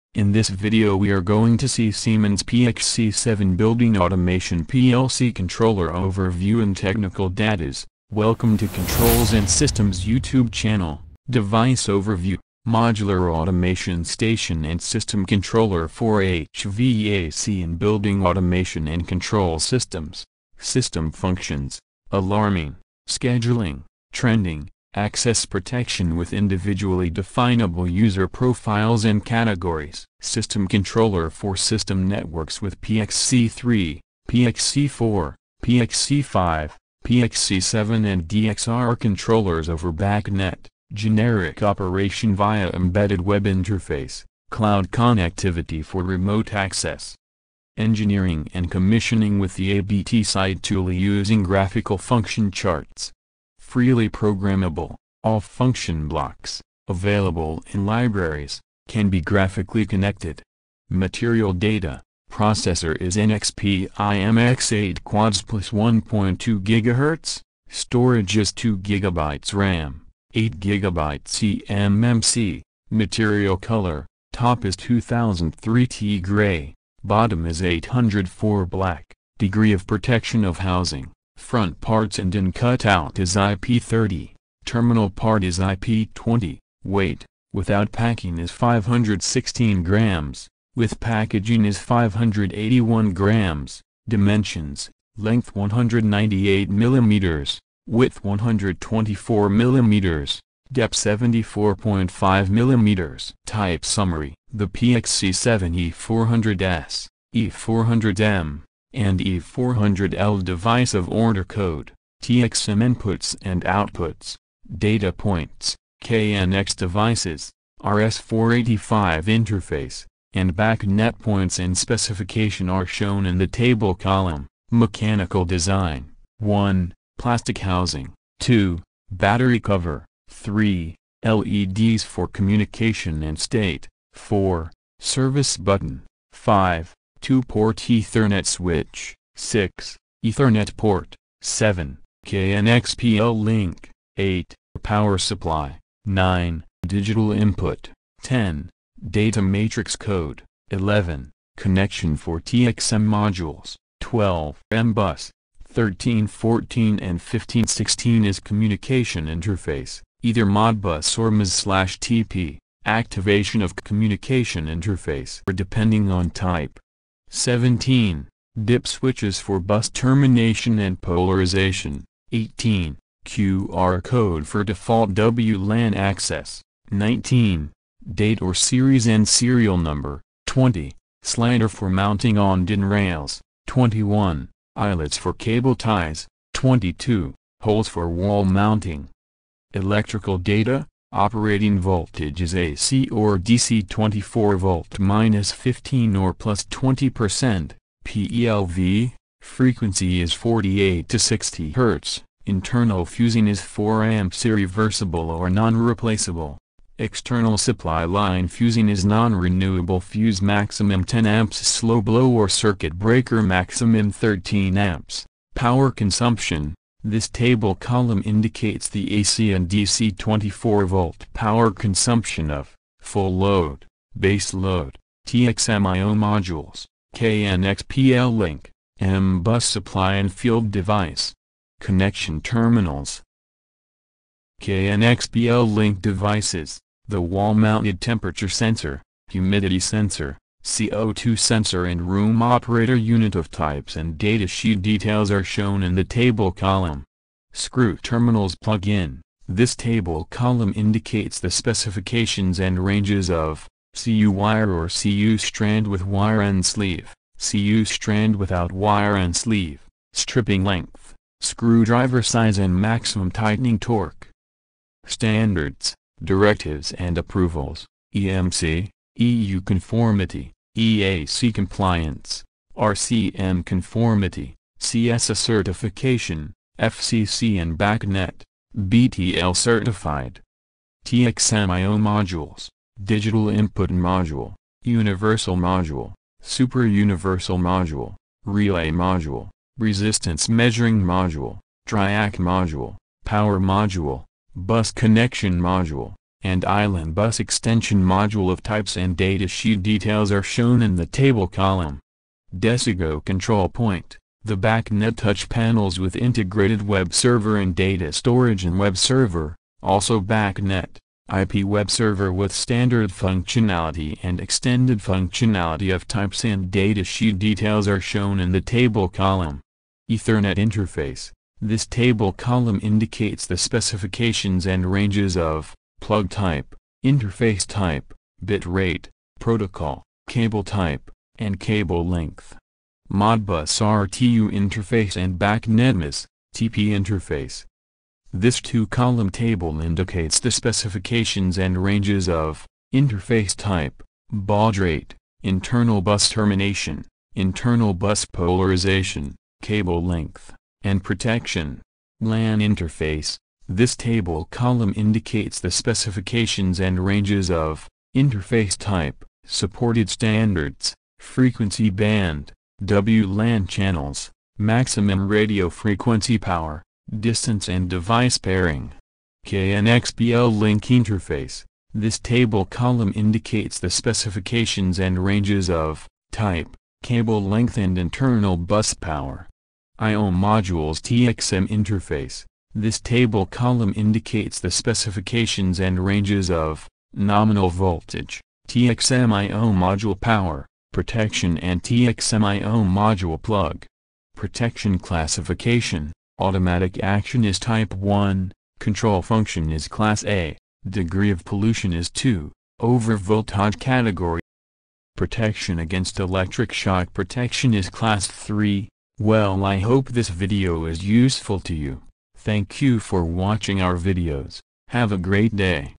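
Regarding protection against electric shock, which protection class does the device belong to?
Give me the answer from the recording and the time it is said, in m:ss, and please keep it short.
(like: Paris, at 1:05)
Class 3, at 6:47.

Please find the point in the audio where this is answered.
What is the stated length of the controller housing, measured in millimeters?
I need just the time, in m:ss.
1:35.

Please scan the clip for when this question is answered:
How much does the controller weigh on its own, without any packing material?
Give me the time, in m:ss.
1:28.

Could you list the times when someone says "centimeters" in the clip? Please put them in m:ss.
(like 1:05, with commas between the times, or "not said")
not said.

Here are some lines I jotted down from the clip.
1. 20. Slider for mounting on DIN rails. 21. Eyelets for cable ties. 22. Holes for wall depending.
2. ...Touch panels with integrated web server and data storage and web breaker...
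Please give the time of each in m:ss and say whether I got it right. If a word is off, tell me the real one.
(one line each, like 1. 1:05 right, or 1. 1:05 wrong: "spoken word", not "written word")
1. 3:00 wrong: "mounting", not "depending"
2. 5:05 wrong: "server", not "breaker".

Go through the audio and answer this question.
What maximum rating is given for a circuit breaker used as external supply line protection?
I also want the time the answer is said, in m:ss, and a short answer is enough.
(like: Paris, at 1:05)
13 amps, at 3:34.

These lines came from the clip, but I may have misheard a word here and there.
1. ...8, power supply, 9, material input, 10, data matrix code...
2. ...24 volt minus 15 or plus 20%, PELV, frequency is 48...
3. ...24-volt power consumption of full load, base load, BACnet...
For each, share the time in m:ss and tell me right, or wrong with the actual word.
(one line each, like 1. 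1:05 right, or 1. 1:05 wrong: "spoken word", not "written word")
1. 2:24 wrong: "digital", not "material"
2. 3:13 right
3. 3:40 wrong: "TXMIO", not "BACnet".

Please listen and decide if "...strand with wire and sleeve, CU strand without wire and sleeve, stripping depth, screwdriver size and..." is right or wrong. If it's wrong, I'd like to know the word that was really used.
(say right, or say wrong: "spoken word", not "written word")
wrong: "length", not "depth".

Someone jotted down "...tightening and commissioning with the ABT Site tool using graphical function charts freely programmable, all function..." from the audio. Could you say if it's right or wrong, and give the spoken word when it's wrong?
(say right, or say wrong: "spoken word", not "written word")
wrong: "engineering", not "tightening".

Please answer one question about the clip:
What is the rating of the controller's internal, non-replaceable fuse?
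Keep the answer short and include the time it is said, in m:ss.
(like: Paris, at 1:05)
4 amps, at 3:23.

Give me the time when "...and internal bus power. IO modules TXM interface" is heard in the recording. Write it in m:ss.
6:17.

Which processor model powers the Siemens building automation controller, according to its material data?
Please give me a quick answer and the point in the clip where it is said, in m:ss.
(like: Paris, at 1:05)
NXP IMX8 quads plus, at 1:03.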